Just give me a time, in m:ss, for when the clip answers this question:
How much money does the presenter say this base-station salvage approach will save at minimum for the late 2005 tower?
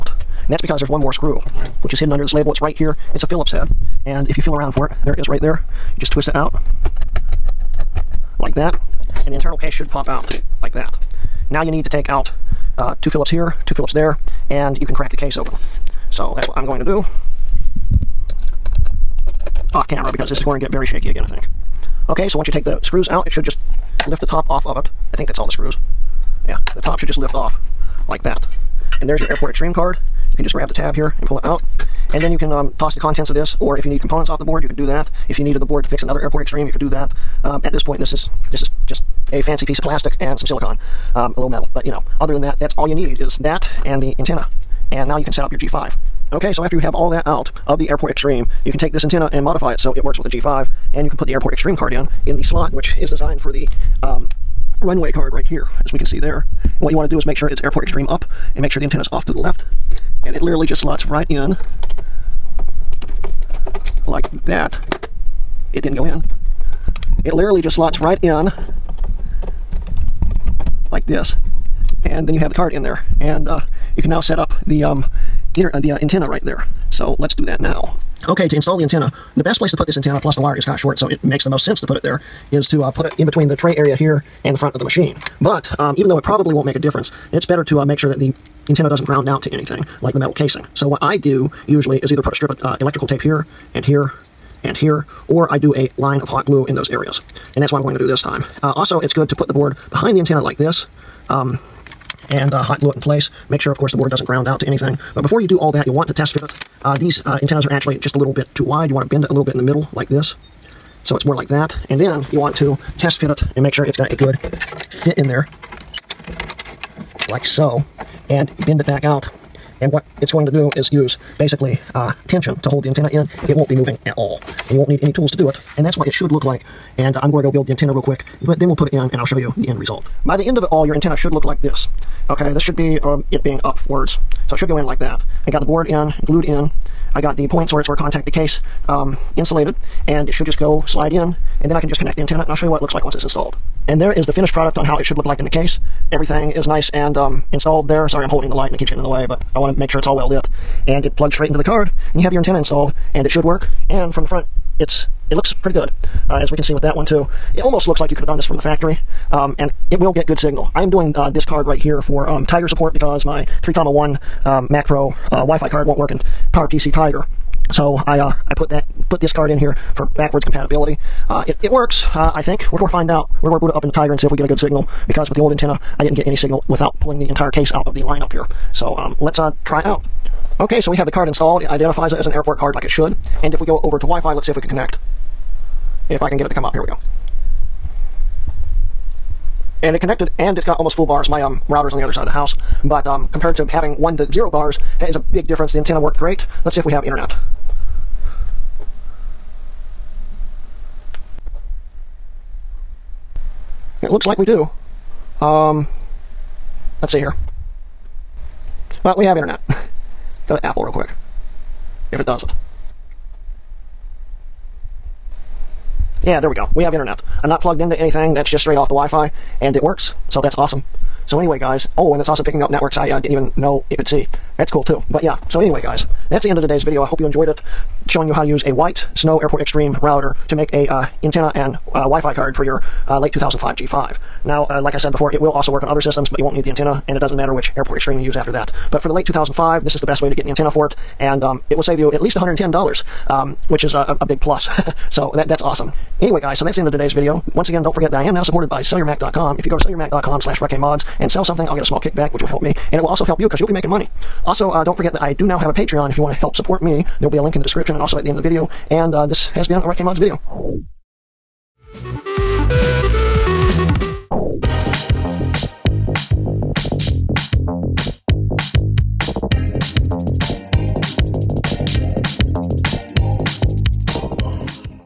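4:02.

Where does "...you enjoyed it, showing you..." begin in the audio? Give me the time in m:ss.
3:47.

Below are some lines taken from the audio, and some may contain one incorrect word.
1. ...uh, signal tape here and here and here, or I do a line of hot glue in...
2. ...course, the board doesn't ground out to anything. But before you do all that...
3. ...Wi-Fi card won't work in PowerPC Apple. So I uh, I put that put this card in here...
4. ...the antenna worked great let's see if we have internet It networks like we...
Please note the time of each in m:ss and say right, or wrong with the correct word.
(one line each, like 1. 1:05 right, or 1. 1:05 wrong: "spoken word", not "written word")
1. 1:32 wrong: "electrical", not "signal"
2. 1:43 right
3. 2:45 wrong: "Tiger", not "Apple"
4. 3:15 wrong: "looks", not "networks".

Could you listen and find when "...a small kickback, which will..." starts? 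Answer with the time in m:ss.
4:11.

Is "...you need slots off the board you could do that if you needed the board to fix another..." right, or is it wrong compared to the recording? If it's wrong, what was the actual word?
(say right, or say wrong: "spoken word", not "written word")
wrong: "components", not "slots".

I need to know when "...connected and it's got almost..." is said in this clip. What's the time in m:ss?
3:09.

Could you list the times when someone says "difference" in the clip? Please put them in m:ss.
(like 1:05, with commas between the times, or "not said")
1:26, 3:15.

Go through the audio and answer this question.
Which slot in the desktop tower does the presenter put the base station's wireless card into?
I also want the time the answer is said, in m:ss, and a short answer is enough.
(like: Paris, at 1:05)
runway card, at 0:54.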